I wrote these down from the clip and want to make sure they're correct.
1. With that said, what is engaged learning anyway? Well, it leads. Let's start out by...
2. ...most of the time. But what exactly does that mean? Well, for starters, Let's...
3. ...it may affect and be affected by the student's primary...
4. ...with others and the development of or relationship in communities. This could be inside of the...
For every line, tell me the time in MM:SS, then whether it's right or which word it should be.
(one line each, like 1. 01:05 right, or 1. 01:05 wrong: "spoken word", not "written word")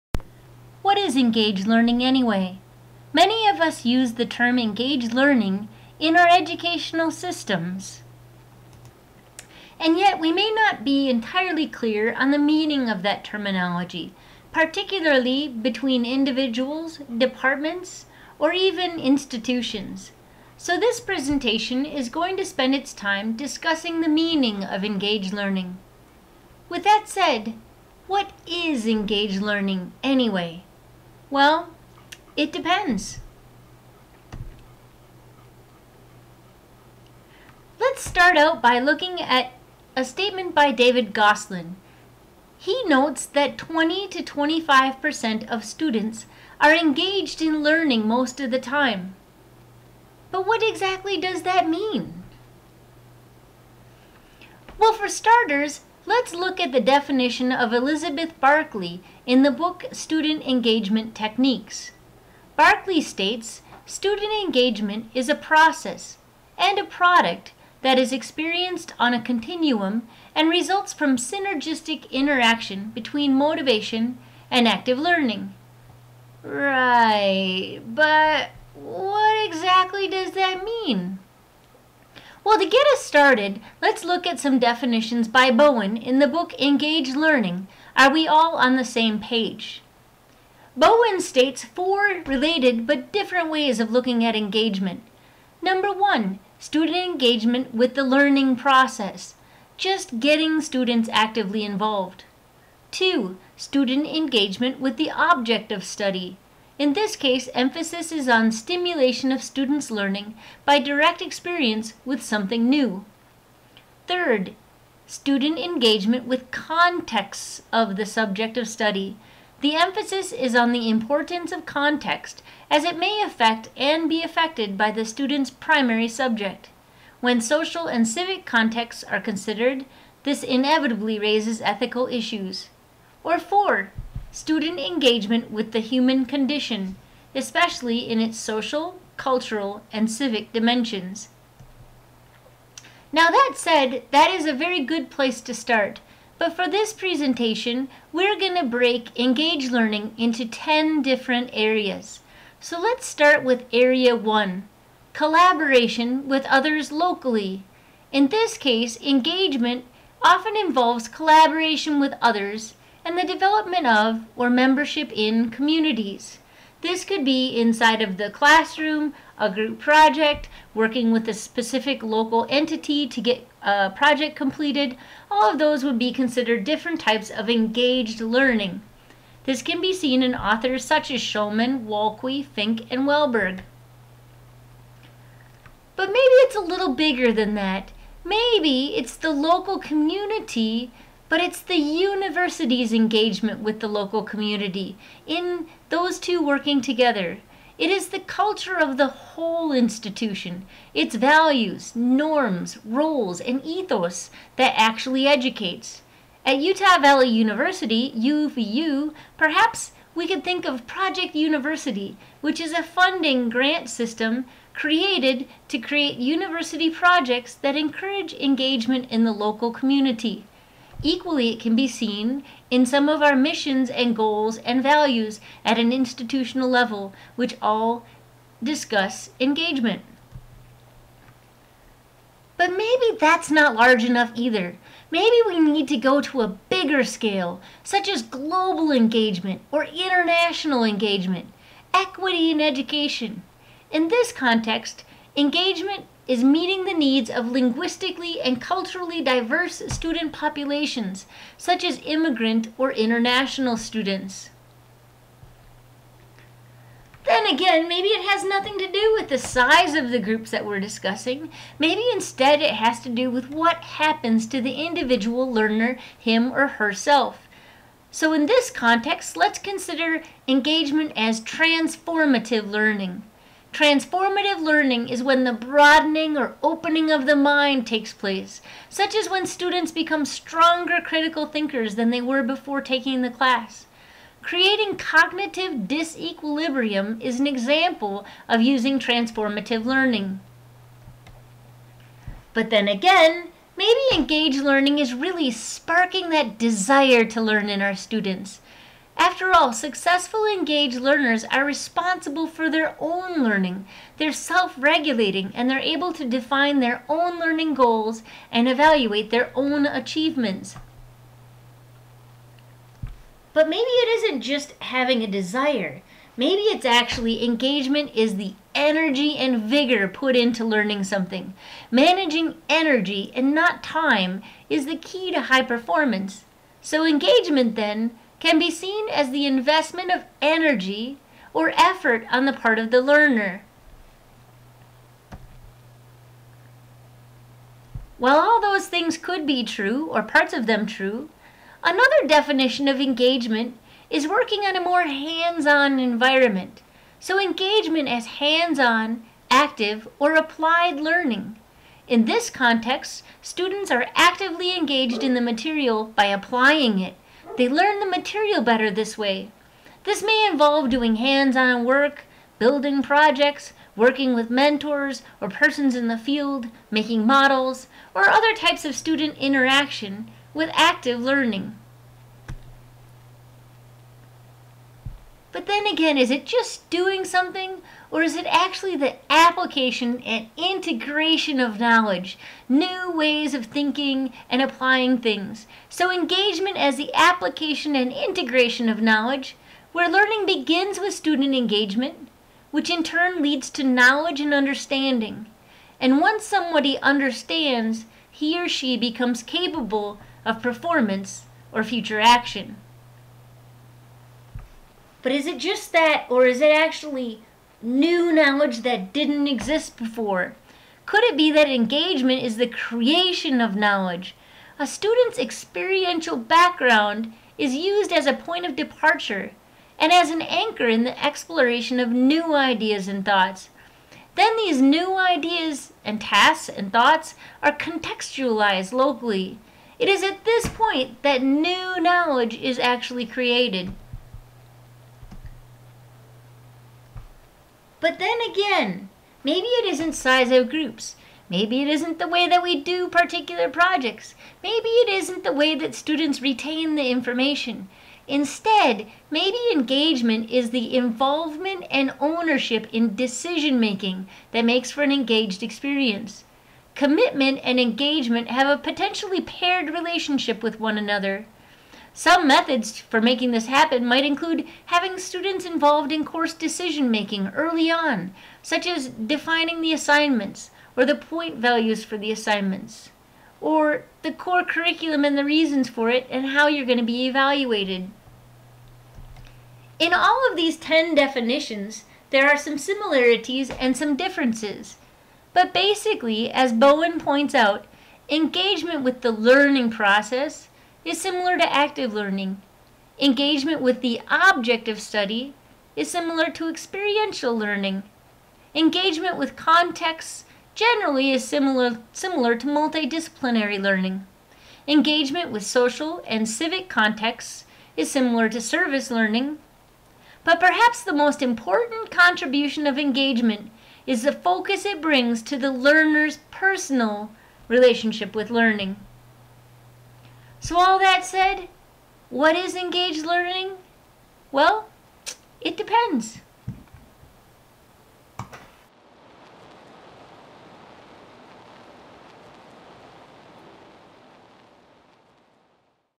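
1. 00:26 wrong: "depends", not "leads"
2. 00:48 right
3. 02:02 right
4. 02:41 wrong: "membership", not "relationship".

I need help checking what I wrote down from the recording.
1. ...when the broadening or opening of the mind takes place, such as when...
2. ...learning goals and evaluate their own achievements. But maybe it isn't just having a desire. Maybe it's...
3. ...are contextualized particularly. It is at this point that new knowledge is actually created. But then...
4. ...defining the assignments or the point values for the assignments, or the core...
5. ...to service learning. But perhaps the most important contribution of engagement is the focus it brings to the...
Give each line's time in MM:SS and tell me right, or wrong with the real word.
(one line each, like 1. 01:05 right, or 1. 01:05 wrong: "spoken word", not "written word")
1. 04:35 right
2. 05:07 right
3. 07:07 wrong: "locally", not "particularly"
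4. 07:49 right
5. 08:28 right.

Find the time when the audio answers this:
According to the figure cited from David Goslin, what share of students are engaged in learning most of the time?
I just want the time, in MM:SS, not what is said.
00:43.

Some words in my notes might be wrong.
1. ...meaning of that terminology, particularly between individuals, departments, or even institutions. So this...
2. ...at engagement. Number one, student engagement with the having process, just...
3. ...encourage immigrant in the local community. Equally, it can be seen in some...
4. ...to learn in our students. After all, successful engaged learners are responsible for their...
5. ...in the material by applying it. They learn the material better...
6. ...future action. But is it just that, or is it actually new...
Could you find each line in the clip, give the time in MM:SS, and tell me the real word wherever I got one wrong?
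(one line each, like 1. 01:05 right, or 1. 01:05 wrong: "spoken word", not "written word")
1. 00:12 right
2. 01:34 wrong: "learning", not "having"
3. 03:37 wrong: "engagement", not "immigrant"
4. 04:57 right
5. 05:55 right
6. 06:41 right.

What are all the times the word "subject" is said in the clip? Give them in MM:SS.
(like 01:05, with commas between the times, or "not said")
01:58, 02:06.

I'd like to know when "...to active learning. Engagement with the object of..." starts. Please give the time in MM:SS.
08:11.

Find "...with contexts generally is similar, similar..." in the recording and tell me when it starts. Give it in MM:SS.
08:19.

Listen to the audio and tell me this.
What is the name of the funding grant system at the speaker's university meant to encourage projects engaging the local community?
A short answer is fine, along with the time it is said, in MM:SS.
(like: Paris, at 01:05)
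Project University, at 03:30.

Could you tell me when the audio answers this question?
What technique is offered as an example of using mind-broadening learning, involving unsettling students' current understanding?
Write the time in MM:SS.
04:44.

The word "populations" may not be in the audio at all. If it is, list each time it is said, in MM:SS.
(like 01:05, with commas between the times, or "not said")
04:10.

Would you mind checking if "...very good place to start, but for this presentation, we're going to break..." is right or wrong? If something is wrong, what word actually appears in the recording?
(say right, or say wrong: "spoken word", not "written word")
right.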